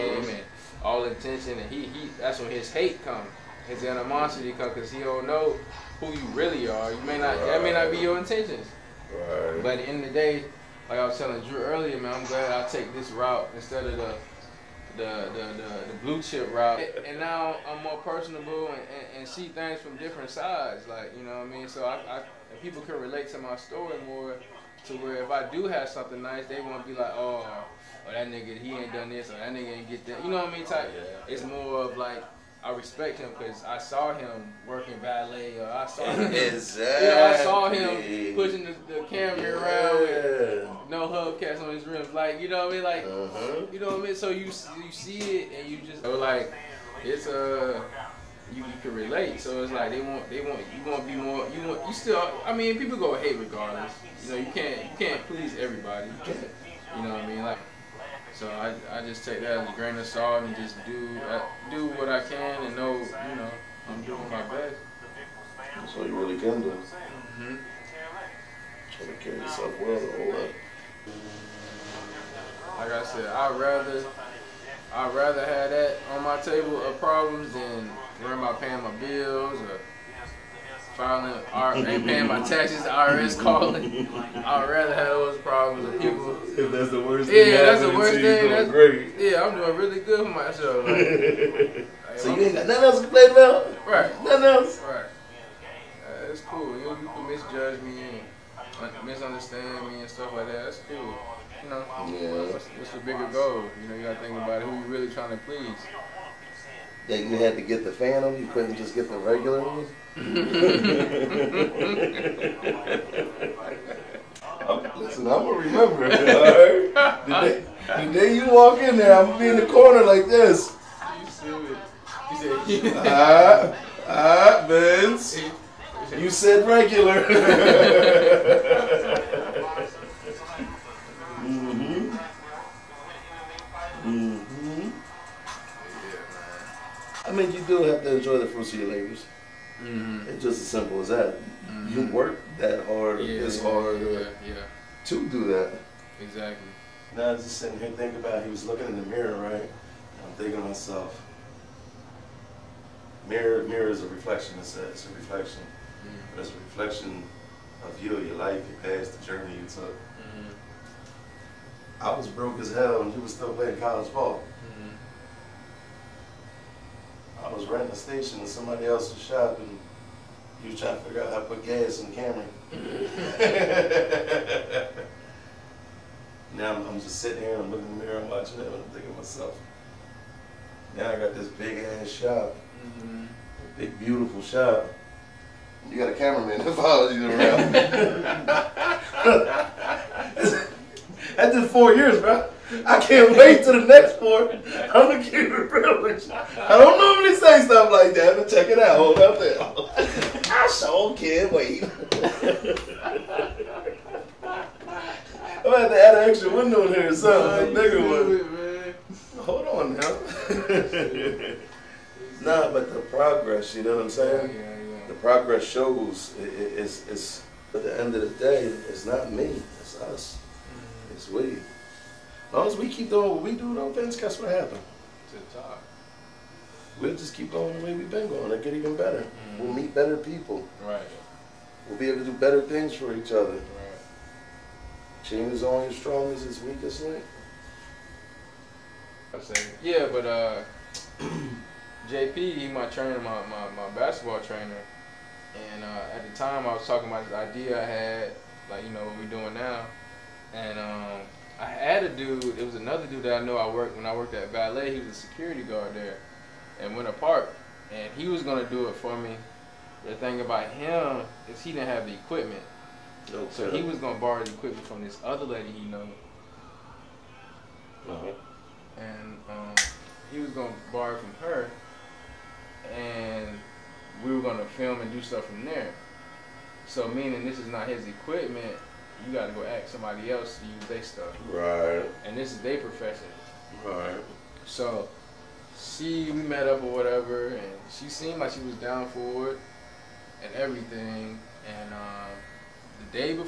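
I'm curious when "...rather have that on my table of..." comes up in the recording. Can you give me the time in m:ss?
1:15.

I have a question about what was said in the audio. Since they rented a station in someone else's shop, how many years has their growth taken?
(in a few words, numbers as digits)
4 years.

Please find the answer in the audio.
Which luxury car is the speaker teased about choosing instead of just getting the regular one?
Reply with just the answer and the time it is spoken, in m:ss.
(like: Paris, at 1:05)
Phantom, at 1:47.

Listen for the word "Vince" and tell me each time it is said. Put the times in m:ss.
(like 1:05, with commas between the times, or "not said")
2:04.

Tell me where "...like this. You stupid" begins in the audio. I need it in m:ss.
2:00.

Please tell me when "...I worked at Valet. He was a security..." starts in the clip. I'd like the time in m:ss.
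4:14.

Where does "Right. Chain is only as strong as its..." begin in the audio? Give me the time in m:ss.
3:53.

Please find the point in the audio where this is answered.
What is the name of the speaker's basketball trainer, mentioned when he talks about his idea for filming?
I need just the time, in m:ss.
4:02.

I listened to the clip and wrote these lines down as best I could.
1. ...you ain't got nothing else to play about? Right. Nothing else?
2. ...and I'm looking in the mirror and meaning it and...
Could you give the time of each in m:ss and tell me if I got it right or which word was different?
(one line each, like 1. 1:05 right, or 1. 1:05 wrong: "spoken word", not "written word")
1. 1:32 right
2. 2:57 wrong: "watching", not "meaning".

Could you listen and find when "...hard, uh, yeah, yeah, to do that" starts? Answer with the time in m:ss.
2:23.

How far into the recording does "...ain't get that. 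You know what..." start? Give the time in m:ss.
0:29.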